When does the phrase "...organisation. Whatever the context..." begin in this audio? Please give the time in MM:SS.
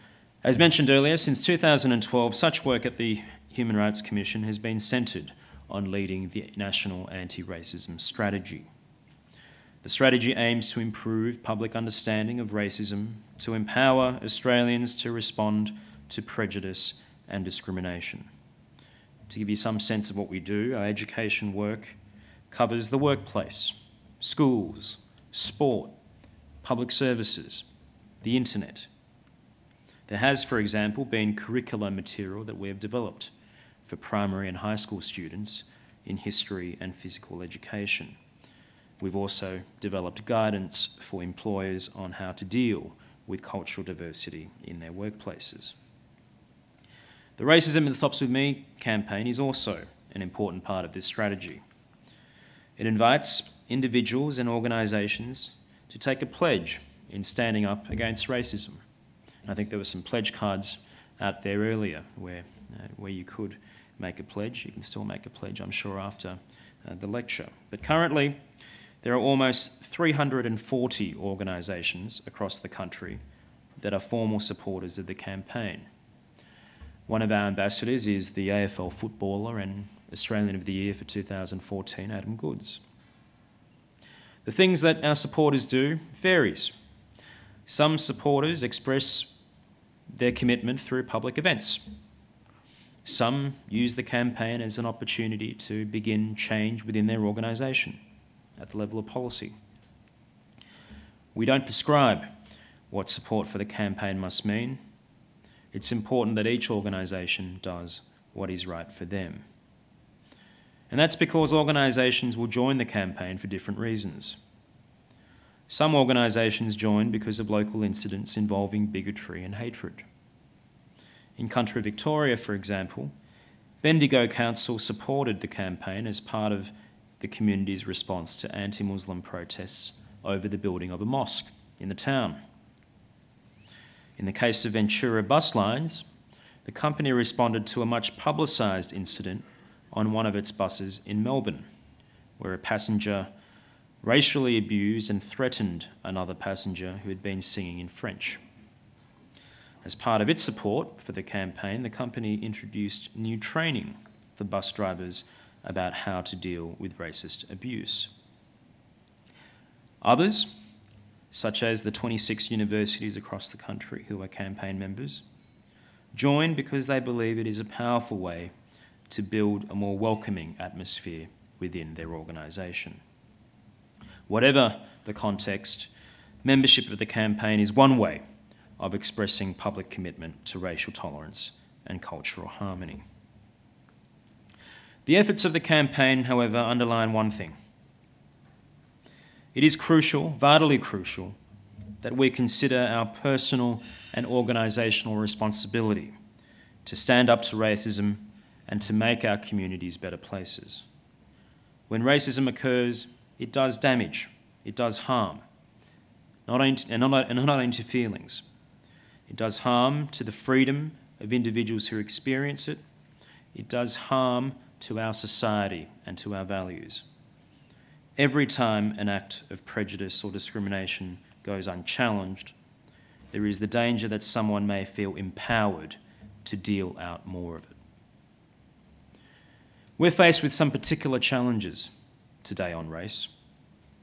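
02:52.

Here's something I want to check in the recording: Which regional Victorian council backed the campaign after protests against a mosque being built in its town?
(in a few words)
Bendigo Council.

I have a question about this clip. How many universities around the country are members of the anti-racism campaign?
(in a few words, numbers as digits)
26.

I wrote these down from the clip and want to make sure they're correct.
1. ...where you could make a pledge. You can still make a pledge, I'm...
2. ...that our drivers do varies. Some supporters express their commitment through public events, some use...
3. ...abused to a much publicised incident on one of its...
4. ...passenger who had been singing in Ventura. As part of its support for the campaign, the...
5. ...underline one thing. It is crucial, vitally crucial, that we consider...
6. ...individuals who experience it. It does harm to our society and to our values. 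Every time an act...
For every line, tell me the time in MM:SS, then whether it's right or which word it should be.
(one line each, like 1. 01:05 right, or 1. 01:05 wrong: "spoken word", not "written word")
1. 01:02 right
2. 01:24 wrong: "supporters", not "drivers"
3. 02:17 wrong: "responded", not "abused"
4. 02:26 wrong: "French", not "Ventura"
5. 03:06 right
6. 03:31 right.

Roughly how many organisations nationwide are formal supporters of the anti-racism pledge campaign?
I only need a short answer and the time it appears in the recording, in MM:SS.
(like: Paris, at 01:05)
340, at 01:09.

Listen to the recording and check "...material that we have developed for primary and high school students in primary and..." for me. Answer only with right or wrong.
wrong.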